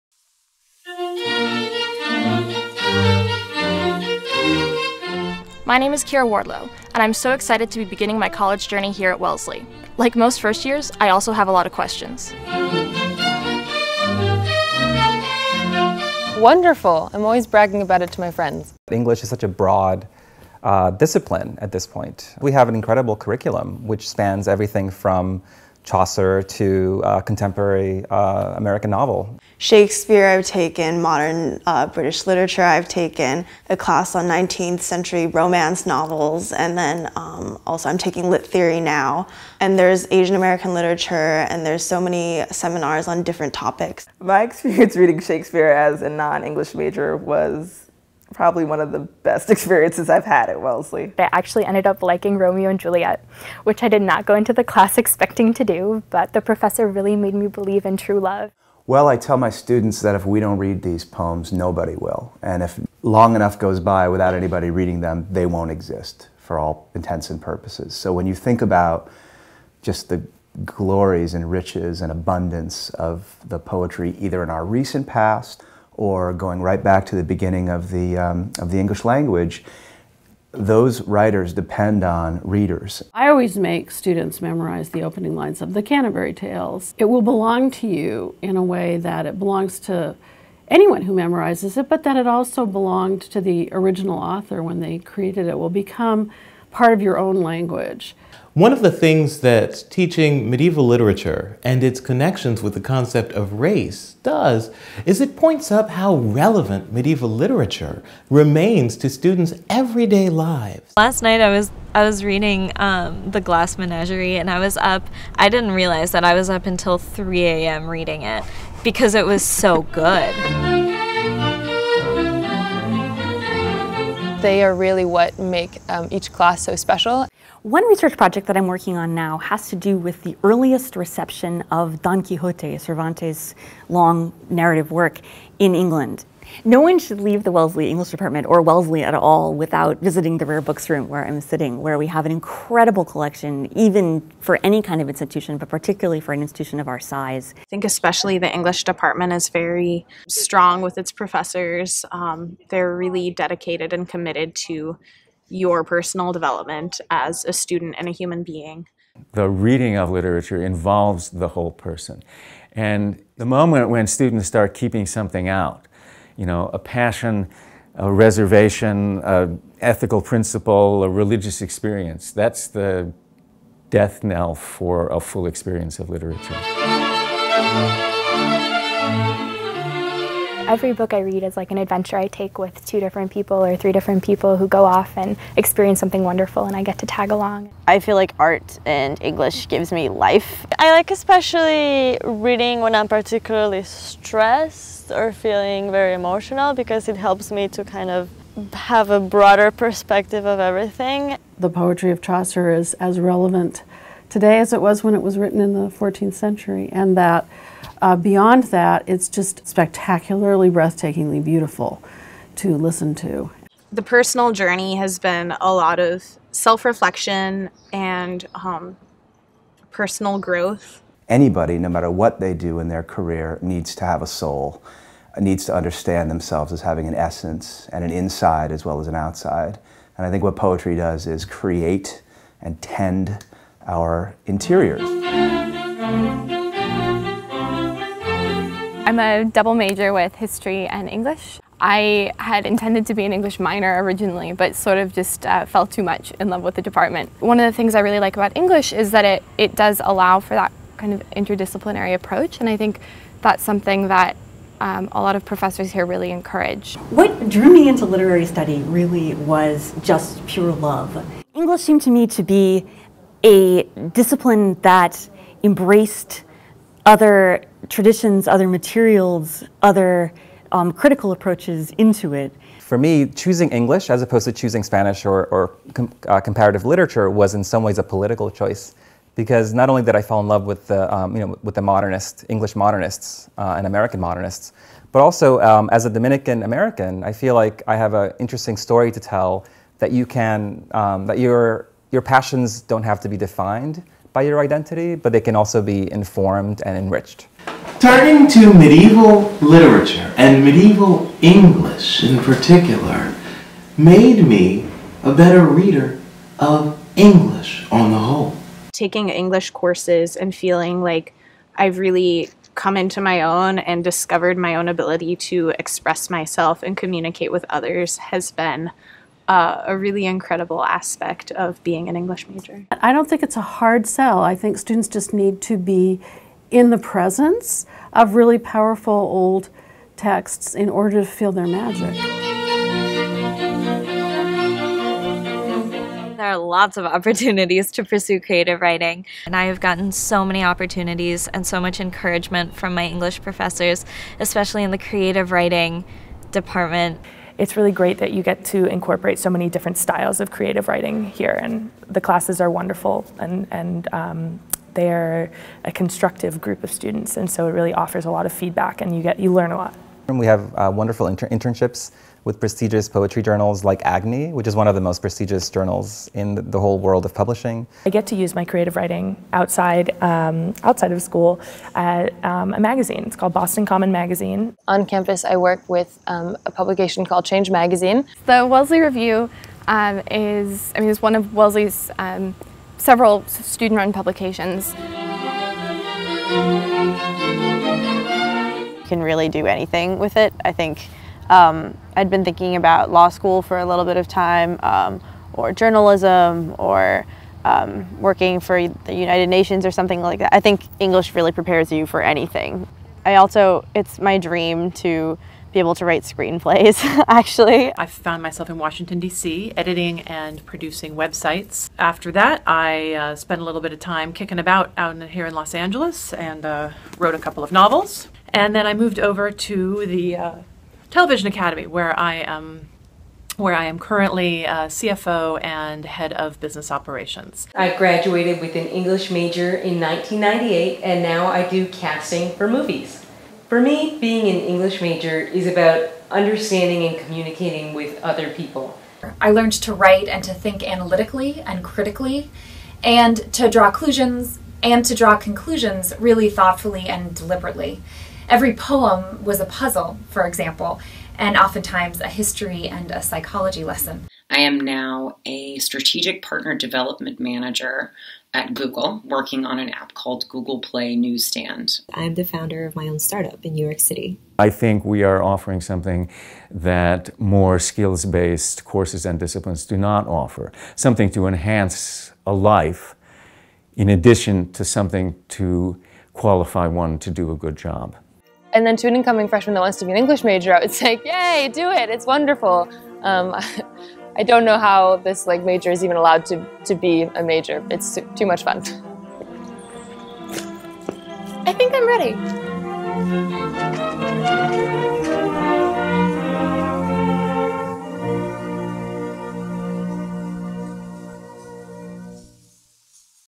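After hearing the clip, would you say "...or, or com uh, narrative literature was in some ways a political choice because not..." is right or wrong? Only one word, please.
wrong.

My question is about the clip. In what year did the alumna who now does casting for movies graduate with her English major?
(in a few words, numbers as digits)
1998.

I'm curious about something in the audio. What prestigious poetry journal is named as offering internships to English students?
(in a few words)
Agni.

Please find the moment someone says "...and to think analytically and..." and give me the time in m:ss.
7:20.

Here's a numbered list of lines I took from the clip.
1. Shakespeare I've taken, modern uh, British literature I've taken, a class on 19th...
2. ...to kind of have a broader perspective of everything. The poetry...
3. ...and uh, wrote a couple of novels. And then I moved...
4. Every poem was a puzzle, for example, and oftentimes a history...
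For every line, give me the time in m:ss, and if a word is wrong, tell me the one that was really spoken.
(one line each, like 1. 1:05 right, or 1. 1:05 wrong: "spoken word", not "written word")
1. 0:29 right
2. 3:17 right
3. 6:56 right
4. 7:28 right.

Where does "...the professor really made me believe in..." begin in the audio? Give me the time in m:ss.
0:56.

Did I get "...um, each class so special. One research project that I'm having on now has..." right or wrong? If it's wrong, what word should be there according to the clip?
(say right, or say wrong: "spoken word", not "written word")
wrong: "working", not "having".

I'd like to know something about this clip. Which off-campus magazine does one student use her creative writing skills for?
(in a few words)
Boston Common Magazine.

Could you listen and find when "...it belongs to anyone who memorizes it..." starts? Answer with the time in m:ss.
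1:29.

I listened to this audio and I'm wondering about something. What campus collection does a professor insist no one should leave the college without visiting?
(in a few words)
Rare Books Room.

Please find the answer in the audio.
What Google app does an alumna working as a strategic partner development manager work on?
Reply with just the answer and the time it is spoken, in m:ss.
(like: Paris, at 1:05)
Google Play Newsstand, at 7:40.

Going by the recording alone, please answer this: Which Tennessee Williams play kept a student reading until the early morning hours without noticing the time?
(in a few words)
The Glass Menagerie.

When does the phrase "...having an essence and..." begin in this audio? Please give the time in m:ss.
3:46.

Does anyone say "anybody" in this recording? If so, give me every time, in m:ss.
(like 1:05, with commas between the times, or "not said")
1:04, 3:41.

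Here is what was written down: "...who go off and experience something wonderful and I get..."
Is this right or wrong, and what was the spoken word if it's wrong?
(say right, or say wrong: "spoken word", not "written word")
right.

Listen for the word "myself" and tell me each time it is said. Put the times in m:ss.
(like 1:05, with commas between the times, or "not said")
5:16, 6:48.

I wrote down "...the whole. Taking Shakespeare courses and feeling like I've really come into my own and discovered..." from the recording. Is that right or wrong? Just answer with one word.
wrong.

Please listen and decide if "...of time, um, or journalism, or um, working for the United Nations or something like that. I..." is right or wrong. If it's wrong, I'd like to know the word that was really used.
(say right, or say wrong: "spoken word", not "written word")
right.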